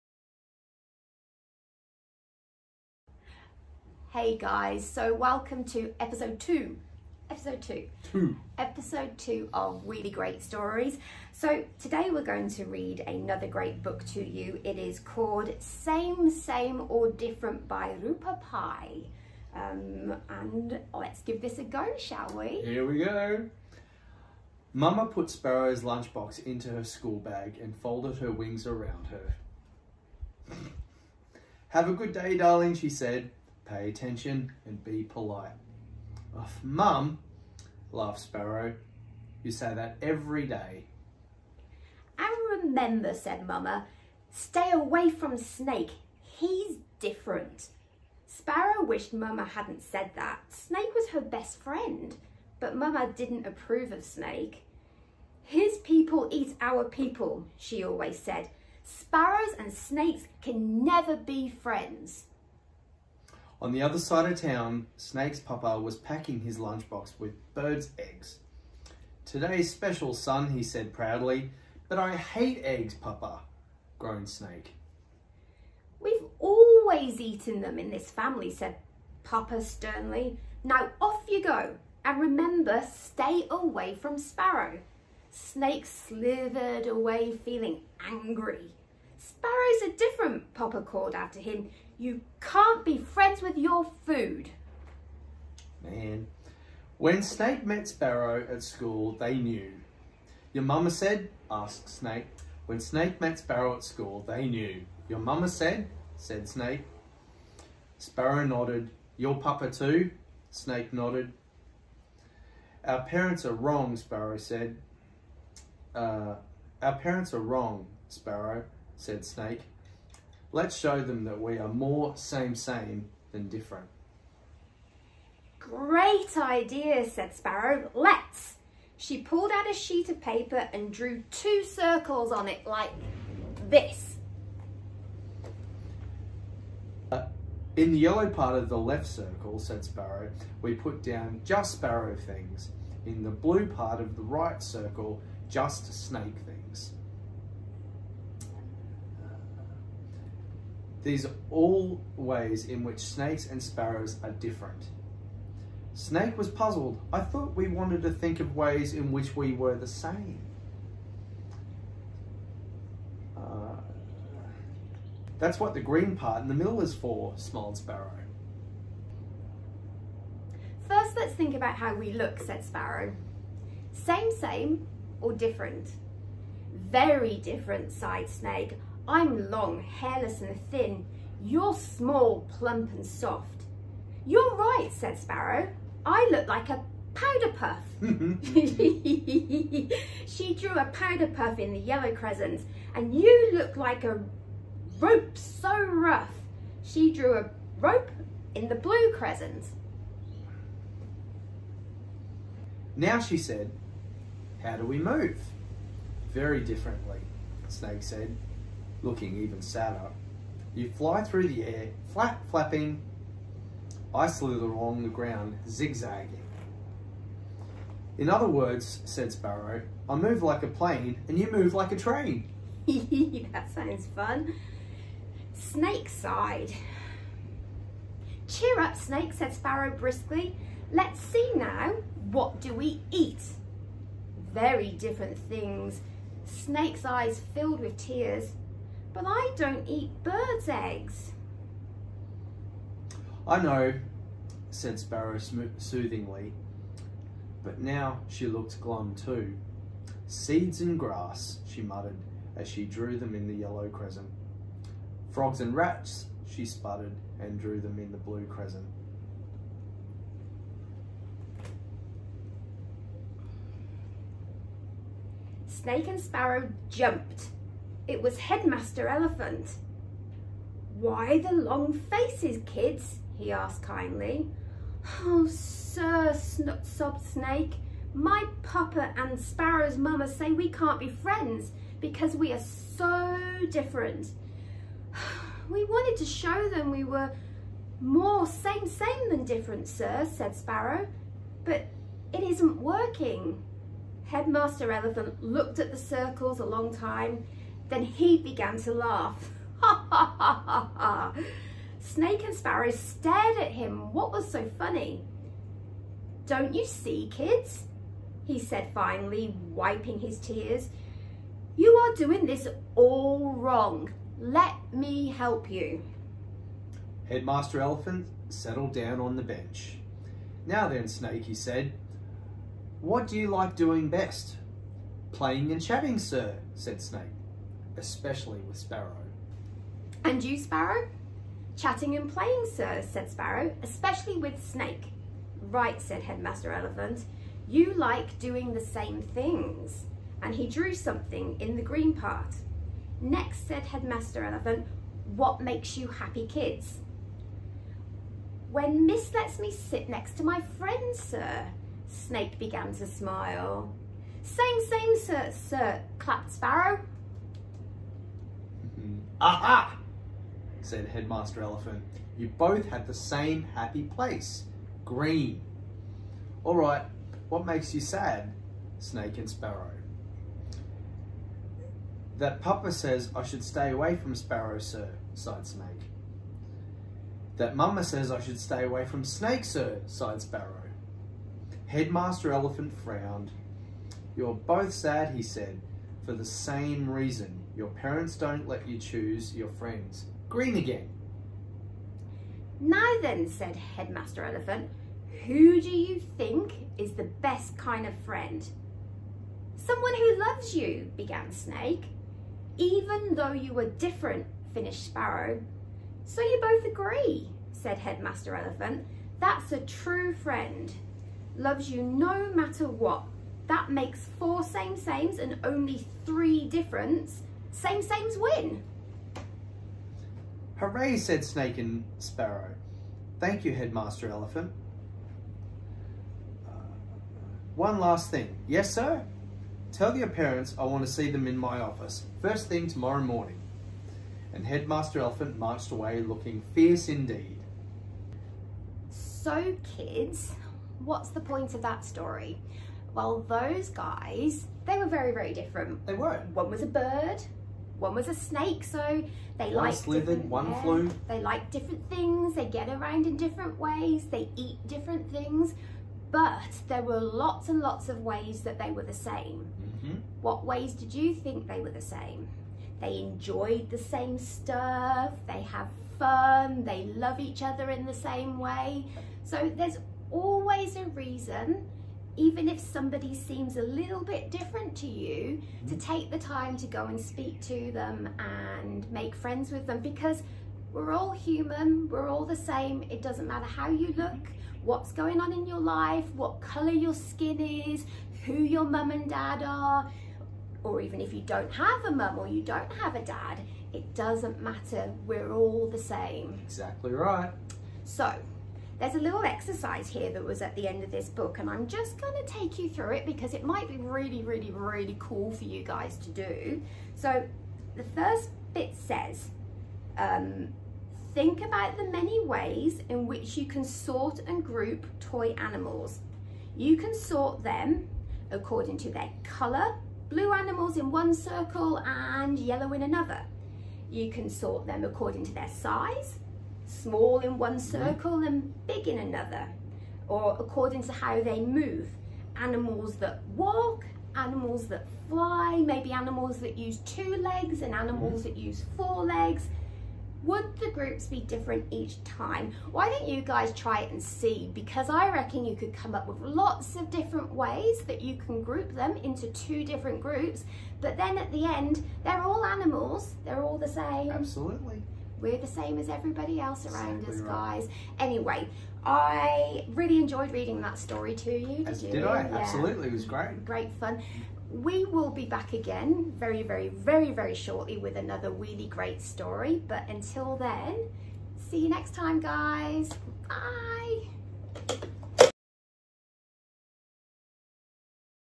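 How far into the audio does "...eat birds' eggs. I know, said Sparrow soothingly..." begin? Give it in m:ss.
3:59.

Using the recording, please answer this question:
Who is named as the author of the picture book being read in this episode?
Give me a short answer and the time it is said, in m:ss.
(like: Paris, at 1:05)
Roopa Pai, at 0:18.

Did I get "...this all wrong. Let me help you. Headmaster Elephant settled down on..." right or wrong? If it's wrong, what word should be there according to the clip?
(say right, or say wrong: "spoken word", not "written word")
right.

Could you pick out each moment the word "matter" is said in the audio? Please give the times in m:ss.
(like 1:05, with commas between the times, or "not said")
6:52, 8:03, 8:14.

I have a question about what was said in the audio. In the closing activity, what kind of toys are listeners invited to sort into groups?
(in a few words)
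Toy animals.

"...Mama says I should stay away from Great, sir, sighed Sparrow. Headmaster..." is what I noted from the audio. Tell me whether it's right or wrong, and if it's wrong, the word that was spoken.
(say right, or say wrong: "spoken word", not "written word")
wrong: "Snake", not "Great".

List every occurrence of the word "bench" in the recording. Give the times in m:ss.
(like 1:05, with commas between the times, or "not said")
5:19.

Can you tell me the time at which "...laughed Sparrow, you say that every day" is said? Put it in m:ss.
0:37.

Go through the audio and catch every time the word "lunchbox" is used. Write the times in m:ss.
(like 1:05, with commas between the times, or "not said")
0:25, 1:06.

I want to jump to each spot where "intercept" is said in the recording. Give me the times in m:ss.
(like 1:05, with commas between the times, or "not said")
not said.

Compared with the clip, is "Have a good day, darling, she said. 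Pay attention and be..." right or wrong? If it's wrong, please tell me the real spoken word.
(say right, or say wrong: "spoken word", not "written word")
right.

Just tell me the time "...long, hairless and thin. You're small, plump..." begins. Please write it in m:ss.
2:59.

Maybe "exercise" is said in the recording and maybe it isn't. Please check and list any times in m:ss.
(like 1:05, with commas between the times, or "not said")
8:19.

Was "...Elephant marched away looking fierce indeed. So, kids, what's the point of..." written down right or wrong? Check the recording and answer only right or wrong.
right.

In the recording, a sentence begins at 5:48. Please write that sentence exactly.
When Miss lets me sit next to my friend, sir, Snake began to smile.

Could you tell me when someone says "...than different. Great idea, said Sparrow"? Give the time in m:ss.
2:03.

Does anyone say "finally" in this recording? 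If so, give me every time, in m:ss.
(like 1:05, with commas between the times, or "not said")
5:08.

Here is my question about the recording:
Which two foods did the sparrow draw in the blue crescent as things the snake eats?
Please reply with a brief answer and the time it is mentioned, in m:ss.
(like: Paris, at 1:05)
Frogs and rats, at 4:15.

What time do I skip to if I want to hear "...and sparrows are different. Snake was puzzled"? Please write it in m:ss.
2:33.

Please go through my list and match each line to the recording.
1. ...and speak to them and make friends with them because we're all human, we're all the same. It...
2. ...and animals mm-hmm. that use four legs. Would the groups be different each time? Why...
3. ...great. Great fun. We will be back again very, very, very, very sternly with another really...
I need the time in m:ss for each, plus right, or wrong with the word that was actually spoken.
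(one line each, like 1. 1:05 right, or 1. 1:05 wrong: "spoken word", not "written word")
1. 7:57 right
2. 8:57 right
3. 9:23 wrong: "shortly", not "sternly".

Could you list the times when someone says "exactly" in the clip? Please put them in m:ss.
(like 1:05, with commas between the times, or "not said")
8:16, 9:17.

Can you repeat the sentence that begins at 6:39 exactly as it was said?
Someone who loves you, began Snake.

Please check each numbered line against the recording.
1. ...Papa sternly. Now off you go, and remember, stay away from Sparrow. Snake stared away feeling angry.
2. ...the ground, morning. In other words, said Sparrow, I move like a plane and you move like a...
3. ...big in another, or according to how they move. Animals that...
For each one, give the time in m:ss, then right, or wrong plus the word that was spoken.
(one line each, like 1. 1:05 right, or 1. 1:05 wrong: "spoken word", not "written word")
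1. 1:19 wrong: "slithered", not "stared"
2. 3:35 wrong: "zigzagging", not "morning"
3. 8:48 right.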